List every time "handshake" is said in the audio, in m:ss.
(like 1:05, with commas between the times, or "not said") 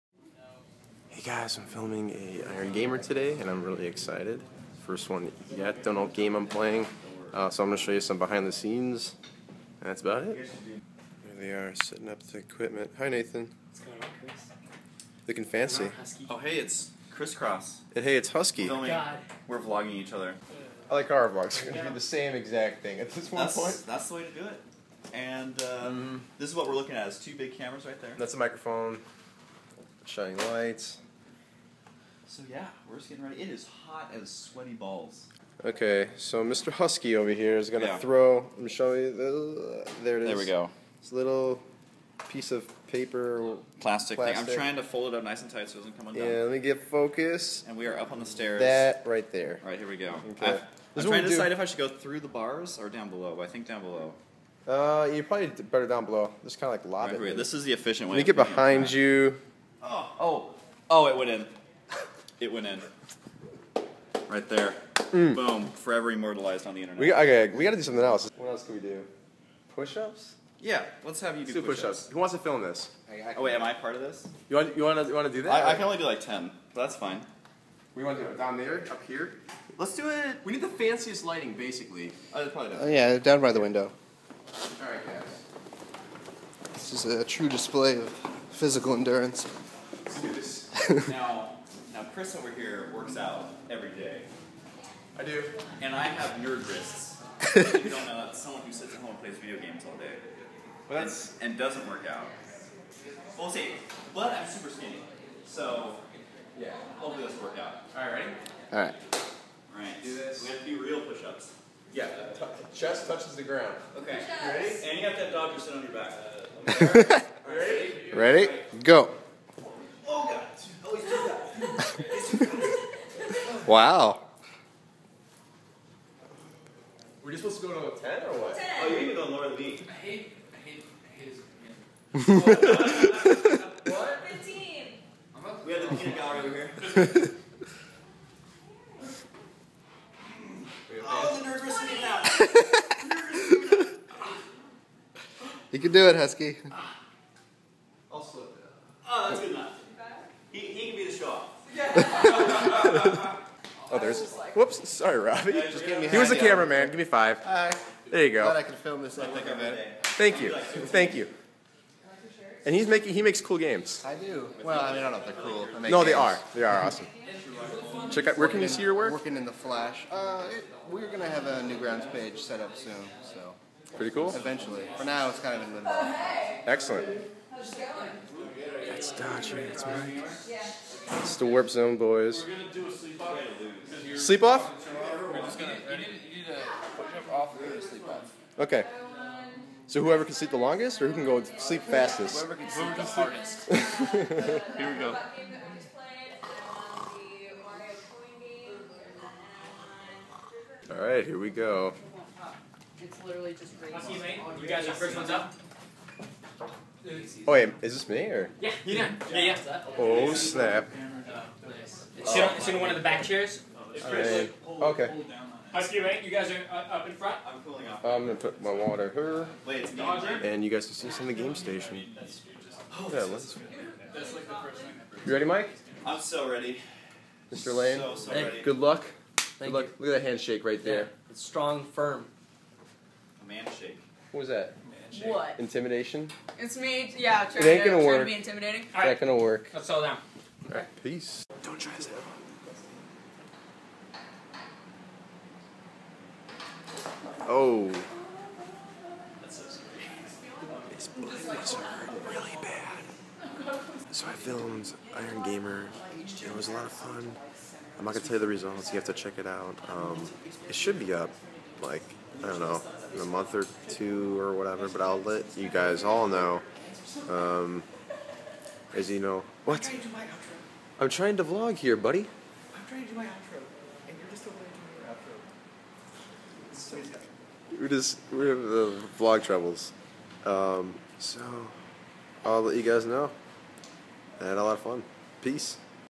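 3:50.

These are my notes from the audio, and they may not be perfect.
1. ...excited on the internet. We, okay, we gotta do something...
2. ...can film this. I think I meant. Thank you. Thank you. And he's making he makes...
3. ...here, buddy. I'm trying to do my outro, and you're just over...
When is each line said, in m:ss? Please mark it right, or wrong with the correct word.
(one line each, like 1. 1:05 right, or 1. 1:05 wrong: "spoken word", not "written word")
1. 1:06 wrong: "immortalized", not "excited"
2. 2:38 right
3. 4:31 right.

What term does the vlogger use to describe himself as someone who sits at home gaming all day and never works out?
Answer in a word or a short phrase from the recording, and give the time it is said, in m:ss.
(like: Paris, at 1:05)
nerd wrists, at 1:36.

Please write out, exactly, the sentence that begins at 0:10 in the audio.
Here they are, setting up the equipment.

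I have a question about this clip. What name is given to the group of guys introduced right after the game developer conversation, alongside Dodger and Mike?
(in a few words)
the Warp Zone boys.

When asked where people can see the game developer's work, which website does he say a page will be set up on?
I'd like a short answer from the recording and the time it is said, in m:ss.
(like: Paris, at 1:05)
Newgrounds, at 2:51.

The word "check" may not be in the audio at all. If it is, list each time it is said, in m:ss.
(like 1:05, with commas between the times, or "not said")
2:48, 4:19.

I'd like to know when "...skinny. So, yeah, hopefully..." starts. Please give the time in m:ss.
1:44.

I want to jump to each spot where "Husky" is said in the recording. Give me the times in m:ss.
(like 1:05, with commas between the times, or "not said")
0:18, 0:36, 2:26, 3:35.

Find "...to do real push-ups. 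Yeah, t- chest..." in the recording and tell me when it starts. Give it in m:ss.
1:50.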